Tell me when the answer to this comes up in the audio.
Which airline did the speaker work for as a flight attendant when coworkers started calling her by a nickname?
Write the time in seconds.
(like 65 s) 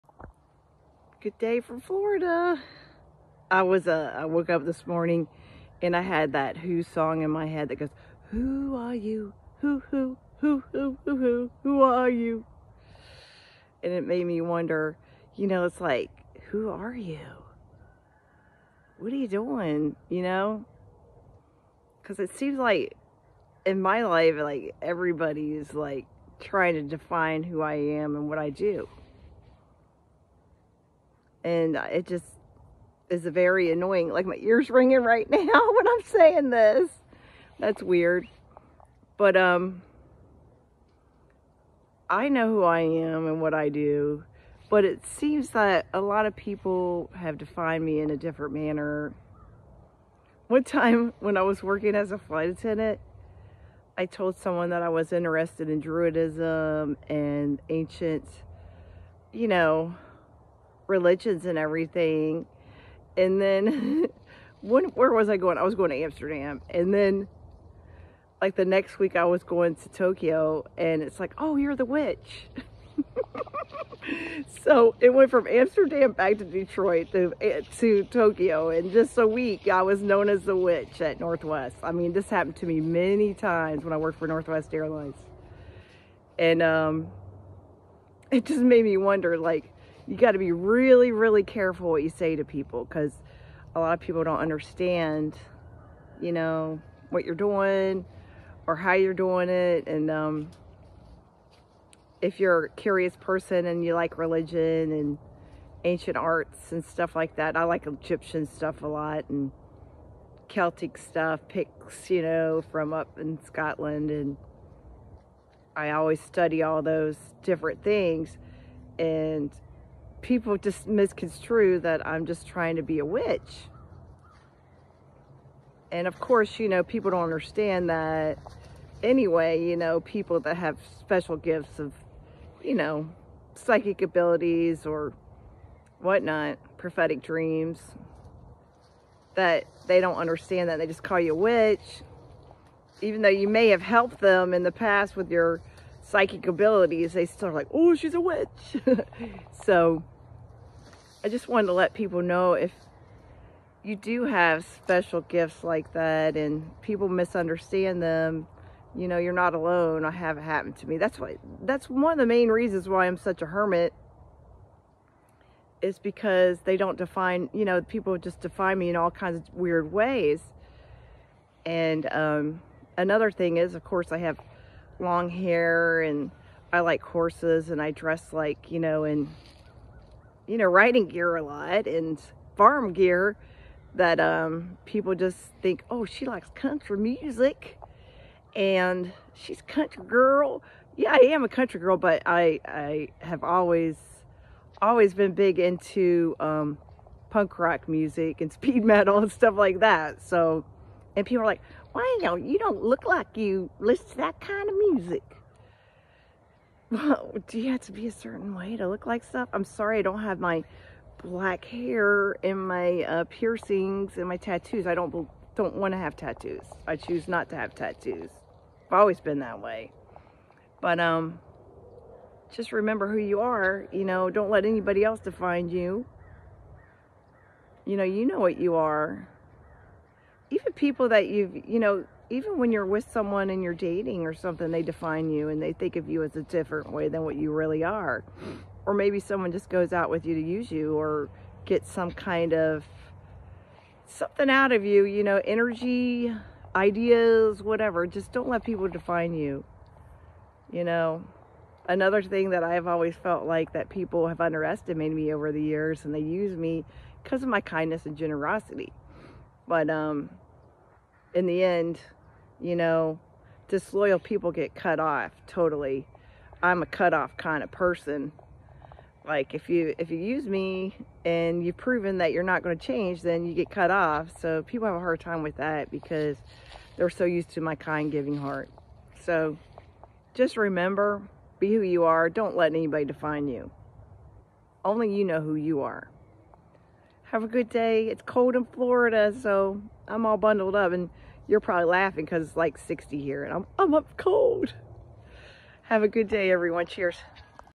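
84 s.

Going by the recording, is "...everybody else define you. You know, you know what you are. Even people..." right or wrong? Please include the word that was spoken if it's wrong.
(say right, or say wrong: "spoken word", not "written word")
wrong: "anybody", not "everybody".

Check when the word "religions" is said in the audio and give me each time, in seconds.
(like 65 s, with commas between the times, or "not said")
60 s, 104 s.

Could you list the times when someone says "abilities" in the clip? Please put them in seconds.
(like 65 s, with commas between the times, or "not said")
134 s, 146 s.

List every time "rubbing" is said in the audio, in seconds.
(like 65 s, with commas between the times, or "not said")
not said.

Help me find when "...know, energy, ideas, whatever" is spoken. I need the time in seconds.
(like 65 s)
245 s.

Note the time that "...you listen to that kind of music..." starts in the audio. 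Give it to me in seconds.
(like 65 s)
203 s.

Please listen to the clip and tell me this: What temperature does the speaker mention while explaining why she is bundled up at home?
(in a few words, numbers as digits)
60.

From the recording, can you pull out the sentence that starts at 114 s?
And I always study all those different things.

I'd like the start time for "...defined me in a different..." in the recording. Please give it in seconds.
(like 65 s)
47 s.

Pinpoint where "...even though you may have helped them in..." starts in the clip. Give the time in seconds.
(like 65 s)
143 s.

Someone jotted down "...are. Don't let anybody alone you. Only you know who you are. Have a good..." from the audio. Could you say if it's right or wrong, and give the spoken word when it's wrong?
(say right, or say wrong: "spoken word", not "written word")
wrong: "define", not "alone".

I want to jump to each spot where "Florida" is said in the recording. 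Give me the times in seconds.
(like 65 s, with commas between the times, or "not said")
1 s, 288 s.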